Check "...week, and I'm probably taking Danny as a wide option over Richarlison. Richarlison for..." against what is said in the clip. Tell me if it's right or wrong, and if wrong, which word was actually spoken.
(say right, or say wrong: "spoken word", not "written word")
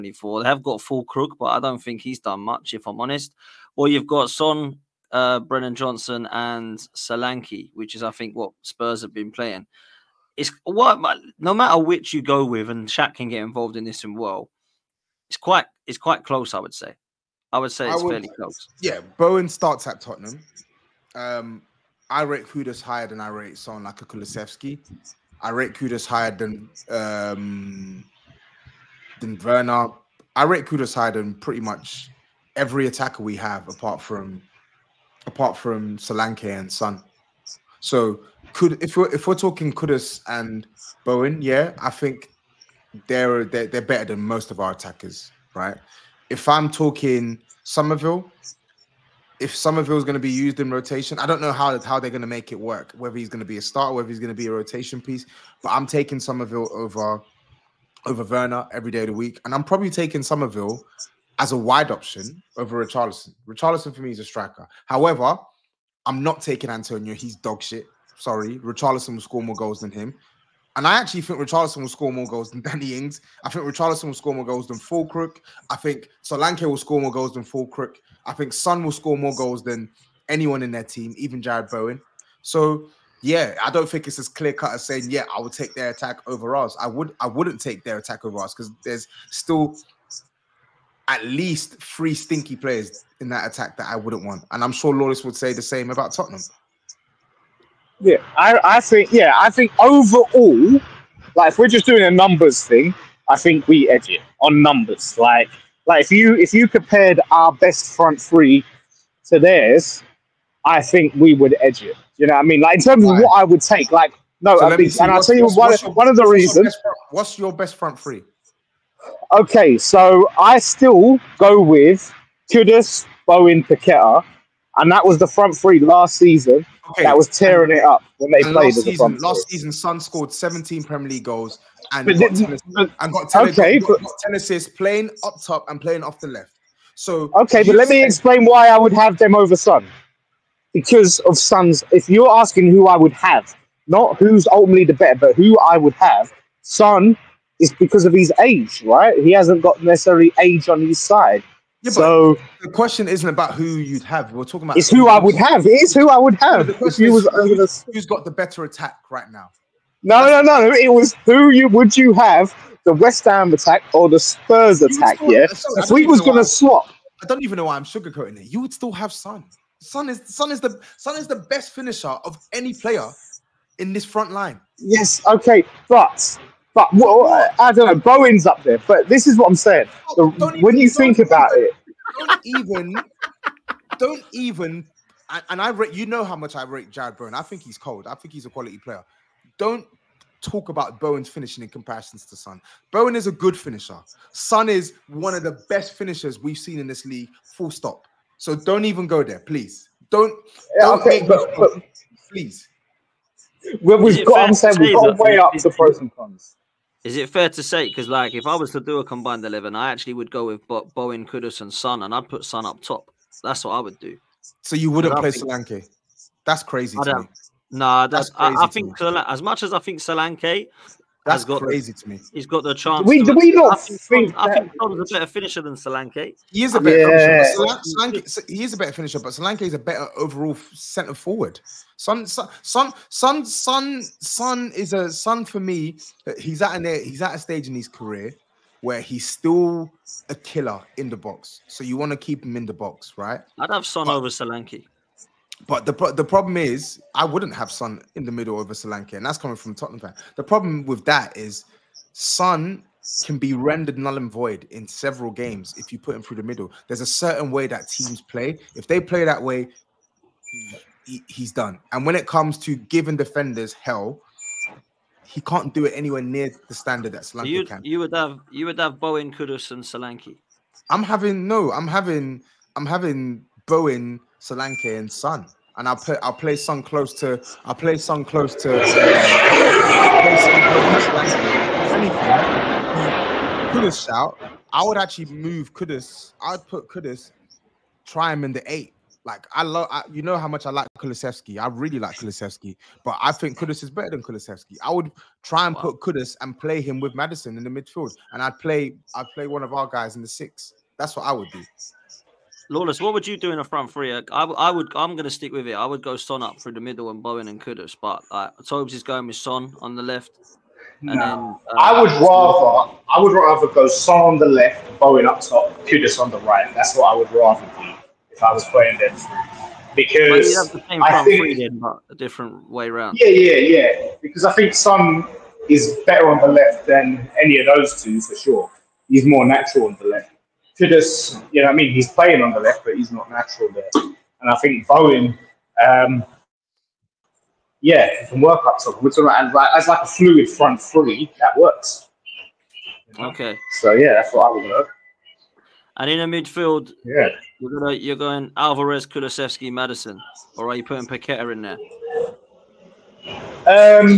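wrong: "Summerville", not "Danny".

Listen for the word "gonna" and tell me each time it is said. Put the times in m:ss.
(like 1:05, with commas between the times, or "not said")
2:46, 5:47.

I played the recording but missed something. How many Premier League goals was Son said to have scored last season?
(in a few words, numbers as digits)
17.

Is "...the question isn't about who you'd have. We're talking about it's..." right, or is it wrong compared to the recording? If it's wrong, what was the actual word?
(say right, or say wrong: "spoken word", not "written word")
right.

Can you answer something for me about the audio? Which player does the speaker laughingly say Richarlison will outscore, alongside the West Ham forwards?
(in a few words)
Danny Ings.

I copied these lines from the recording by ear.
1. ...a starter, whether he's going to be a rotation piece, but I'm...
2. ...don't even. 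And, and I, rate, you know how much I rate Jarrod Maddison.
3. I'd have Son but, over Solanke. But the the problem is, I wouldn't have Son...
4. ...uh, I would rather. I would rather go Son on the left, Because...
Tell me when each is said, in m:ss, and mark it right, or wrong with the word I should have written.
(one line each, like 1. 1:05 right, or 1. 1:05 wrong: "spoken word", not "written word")
1. 0:53 right
2. 3:03 wrong: "Bowen", not "Maddison"
3. 4:03 right
4. 5:11 wrong: "Bowen", not "Because".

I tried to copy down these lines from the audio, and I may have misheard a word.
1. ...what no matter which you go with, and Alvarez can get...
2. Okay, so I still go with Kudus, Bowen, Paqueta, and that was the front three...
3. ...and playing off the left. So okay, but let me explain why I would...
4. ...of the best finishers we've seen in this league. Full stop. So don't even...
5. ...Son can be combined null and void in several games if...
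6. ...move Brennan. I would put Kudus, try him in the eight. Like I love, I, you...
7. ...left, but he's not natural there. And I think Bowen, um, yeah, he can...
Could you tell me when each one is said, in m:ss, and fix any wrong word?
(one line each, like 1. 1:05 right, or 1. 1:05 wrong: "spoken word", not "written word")
1. 0:10 wrong: "Shaq", not "Alvarez"
2. 1:59 right
3. 2:15 right
4. 3:15 right
5. 4:12 wrong: "rendered", not "combined"
6. 4:45 wrong: "Kudus", not "Brennan"
7. 5:32 right.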